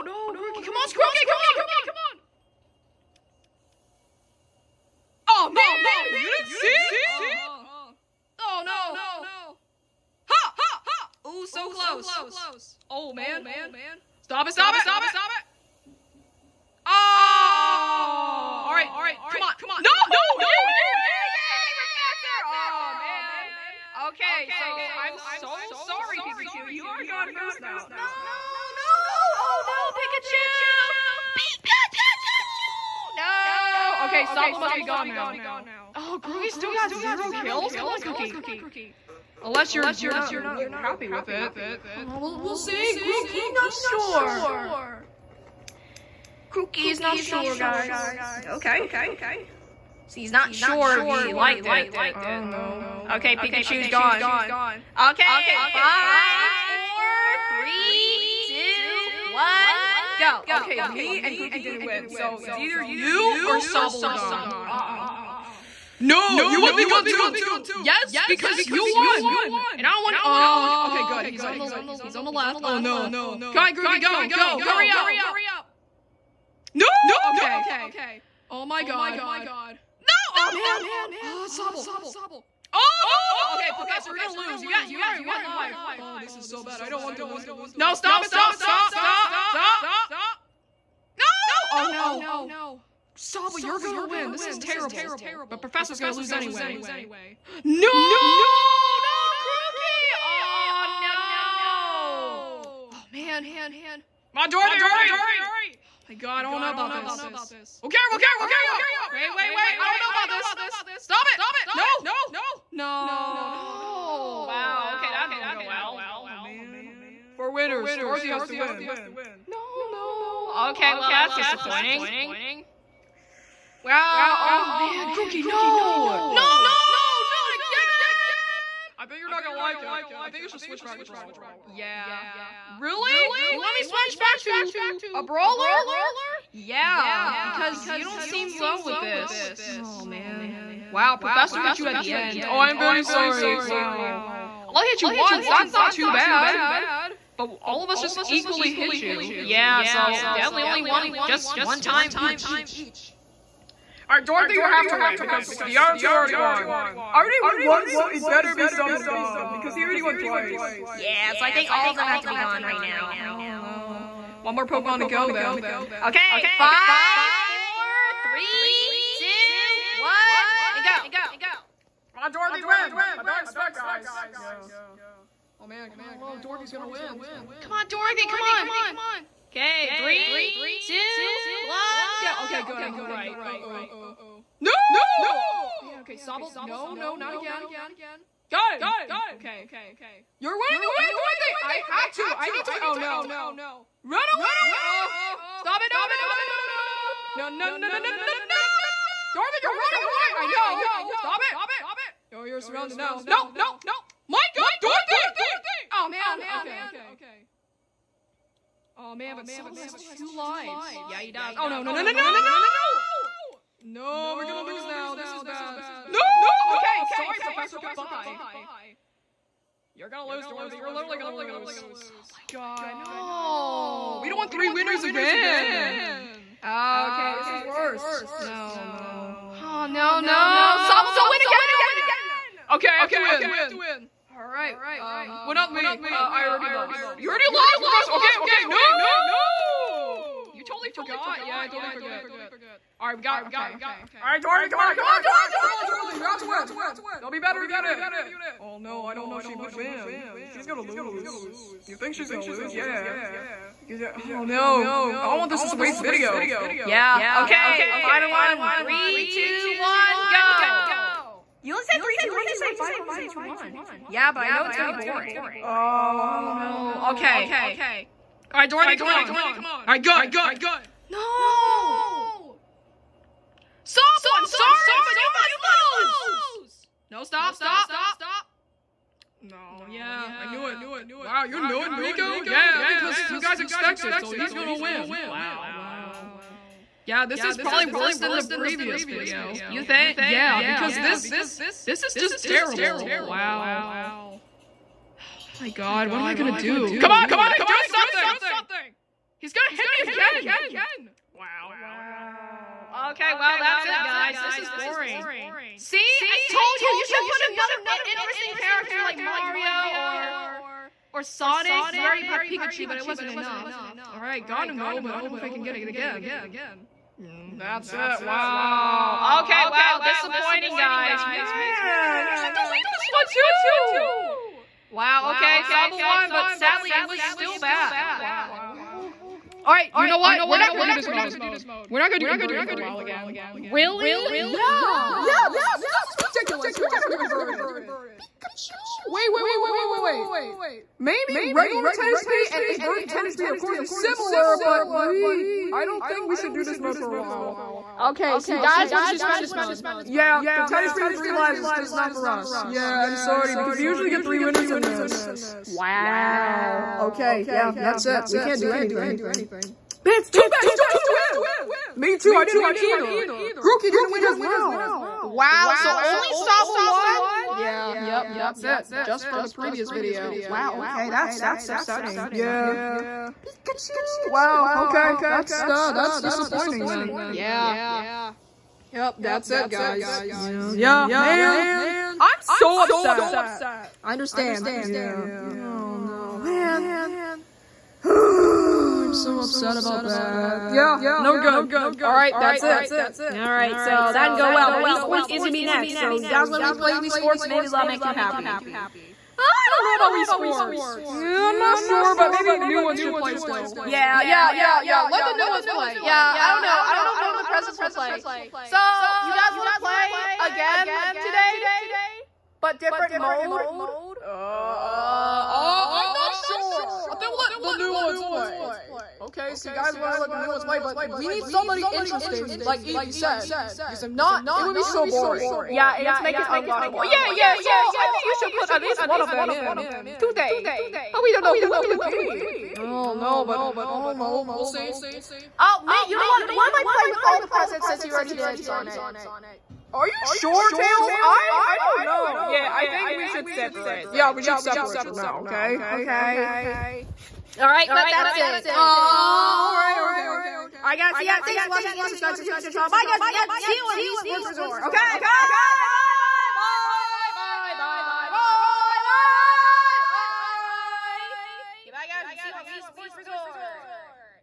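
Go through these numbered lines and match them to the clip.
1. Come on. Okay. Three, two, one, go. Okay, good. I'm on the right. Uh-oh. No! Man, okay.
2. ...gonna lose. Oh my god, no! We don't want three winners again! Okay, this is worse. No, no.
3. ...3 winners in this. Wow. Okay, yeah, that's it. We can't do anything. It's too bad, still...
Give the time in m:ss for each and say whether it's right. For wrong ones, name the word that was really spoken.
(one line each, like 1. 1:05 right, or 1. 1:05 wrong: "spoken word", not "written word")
1. 2:58 right
2. 3:41 right
3. 5:54 right.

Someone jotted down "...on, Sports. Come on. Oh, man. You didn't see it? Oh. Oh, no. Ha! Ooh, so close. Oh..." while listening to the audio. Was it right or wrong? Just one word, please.
wrong.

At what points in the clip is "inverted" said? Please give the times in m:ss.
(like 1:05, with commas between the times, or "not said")
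5:32, 5:37, 5:42.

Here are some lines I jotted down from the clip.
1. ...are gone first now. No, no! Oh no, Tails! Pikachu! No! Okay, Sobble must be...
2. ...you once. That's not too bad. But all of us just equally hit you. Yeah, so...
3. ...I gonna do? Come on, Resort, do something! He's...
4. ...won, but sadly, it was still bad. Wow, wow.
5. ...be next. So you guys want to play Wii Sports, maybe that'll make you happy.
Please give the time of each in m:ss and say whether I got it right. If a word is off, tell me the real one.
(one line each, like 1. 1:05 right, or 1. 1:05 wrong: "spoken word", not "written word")
1. 0:26 wrong: "Pikachu", not "Tails"
2. 2:25 right
3. 4:56 wrong: "Dorothy", not "Resort"
4. 5:26 right
5. 6:35 right.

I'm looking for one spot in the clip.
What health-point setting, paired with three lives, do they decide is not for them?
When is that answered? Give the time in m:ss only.
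5:50.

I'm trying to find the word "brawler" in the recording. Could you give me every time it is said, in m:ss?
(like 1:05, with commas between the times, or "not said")
2:11, 2:15.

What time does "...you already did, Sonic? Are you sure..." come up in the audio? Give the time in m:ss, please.
7:18.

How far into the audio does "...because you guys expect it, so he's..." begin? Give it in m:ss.
4:42.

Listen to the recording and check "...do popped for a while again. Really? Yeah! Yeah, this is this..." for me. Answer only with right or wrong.
wrong.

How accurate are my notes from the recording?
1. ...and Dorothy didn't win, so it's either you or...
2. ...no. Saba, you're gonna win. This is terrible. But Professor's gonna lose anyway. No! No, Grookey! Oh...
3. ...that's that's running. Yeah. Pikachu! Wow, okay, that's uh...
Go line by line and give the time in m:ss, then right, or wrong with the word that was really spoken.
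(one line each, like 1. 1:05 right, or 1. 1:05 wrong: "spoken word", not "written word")
1. 1:01 wrong: "Grookey", not "Dorothy"
2. 1:31 right
3. 6:11 wrong: "upsetting", not "running".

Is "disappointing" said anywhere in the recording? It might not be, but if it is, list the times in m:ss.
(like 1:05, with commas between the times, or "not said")
2:01, 5:20, 6:16.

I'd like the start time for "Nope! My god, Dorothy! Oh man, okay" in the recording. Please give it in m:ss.
3:23.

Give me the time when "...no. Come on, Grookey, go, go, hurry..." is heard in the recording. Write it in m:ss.
1:12.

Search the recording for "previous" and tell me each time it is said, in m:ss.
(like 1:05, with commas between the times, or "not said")
4:48, 6:09.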